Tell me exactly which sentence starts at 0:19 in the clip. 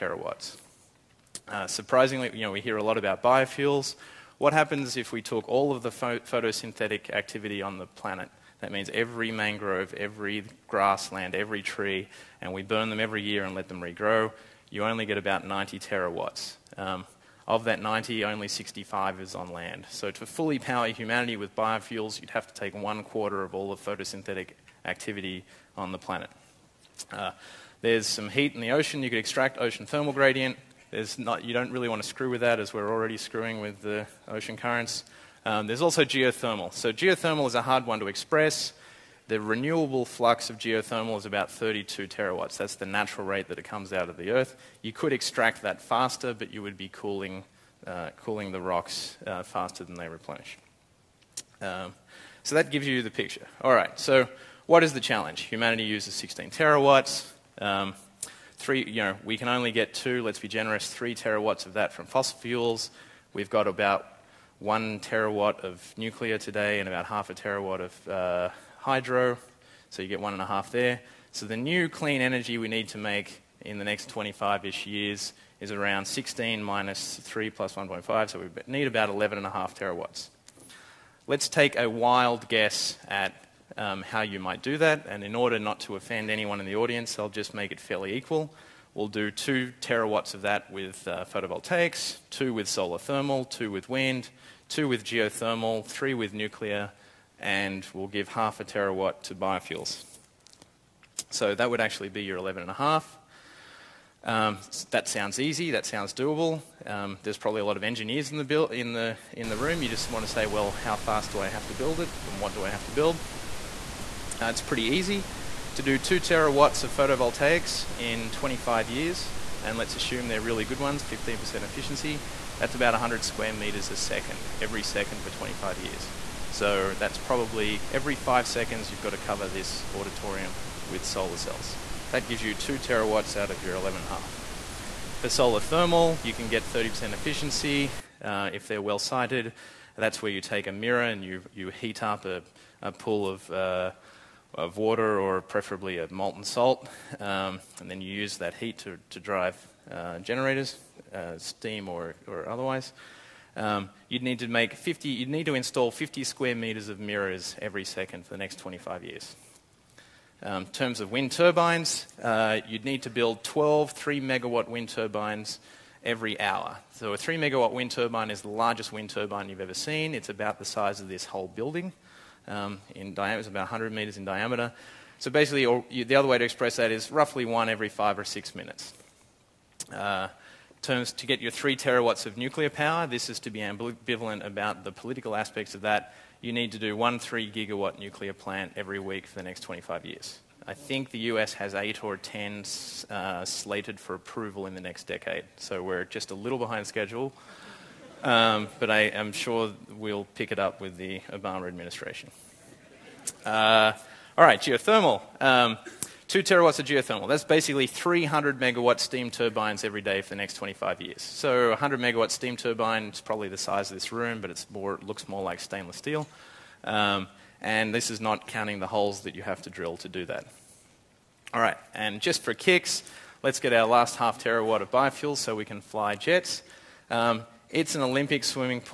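So to fully power humanity with biofuels, you'd have to take one quarter of all the photosynthetic activity on the planet.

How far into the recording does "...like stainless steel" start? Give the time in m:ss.
3:35.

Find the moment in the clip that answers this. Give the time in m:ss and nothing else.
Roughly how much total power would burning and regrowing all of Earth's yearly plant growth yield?
0:15.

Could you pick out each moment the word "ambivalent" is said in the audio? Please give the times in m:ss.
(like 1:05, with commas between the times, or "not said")
3:03.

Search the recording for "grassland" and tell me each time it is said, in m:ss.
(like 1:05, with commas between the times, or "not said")
0:10.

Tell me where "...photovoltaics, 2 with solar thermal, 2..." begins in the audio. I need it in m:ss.
1:31.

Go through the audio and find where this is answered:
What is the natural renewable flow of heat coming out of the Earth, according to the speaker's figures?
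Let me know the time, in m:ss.
0:41.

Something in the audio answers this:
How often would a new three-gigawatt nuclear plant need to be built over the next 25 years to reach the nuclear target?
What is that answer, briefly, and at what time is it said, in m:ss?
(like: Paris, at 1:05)
every week, at 3:08.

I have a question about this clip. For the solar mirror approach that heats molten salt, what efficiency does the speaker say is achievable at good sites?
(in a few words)
30%.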